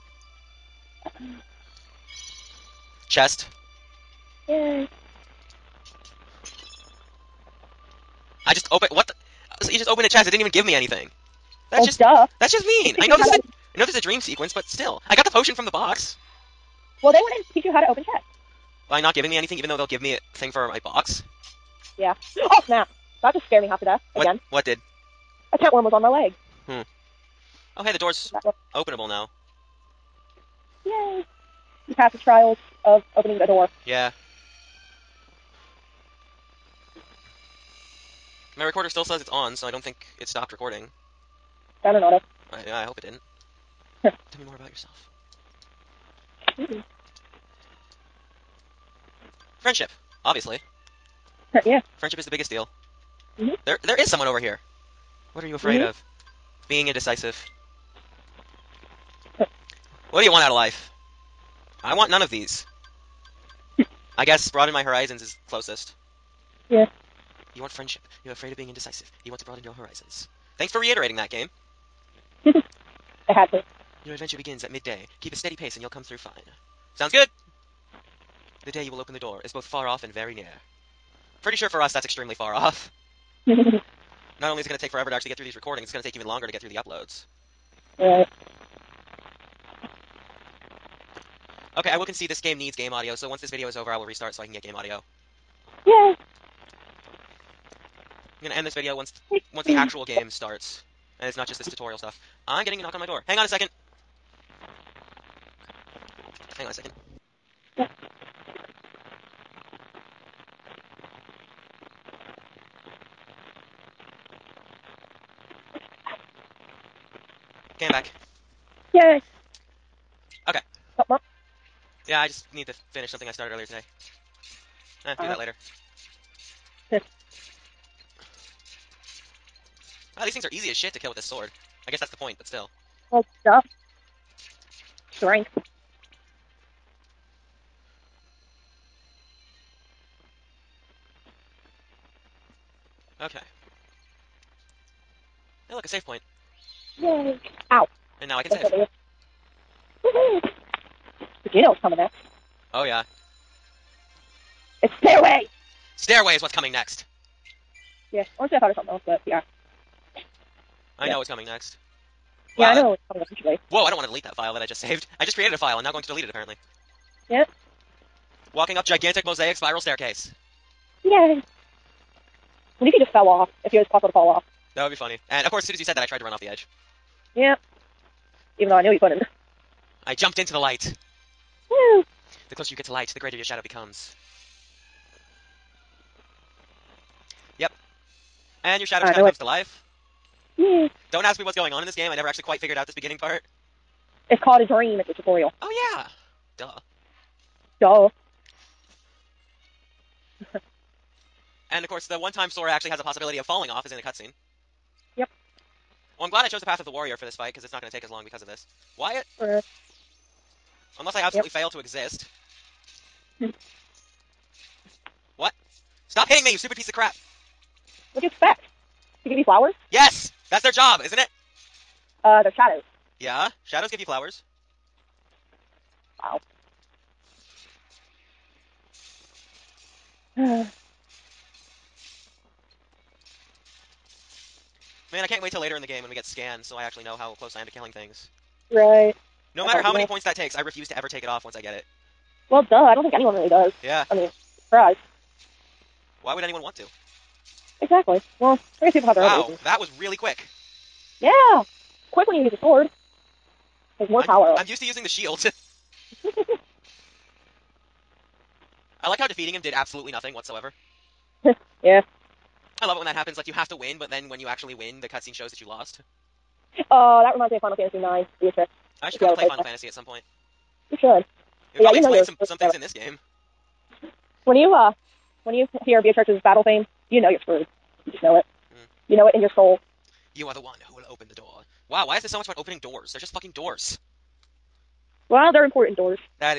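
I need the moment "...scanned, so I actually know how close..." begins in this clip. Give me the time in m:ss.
3:56.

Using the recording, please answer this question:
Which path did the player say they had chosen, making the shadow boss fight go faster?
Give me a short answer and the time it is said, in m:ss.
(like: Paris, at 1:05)
The path of the warrior, at 3:26.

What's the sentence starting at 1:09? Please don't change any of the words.
You want to broaden your horizons.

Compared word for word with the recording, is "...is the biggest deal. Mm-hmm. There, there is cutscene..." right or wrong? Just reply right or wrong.
wrong.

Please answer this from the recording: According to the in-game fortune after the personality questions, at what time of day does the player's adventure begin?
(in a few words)
Midday.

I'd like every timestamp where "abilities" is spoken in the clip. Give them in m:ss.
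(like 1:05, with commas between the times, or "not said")
not said.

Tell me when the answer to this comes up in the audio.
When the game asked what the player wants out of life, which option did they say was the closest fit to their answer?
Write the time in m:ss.
1:04.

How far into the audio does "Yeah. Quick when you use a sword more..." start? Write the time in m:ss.
4:11.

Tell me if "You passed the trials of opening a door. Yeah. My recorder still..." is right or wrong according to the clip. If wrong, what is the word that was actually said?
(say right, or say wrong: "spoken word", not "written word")
right.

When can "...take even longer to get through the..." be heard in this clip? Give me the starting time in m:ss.
1:26.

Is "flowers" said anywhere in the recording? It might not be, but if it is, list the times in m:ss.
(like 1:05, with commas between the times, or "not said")
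3:39, 3:44.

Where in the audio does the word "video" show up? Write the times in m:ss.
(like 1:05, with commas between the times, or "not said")
1:33, 1:38.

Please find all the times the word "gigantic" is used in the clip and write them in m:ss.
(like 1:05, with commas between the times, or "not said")
2:48.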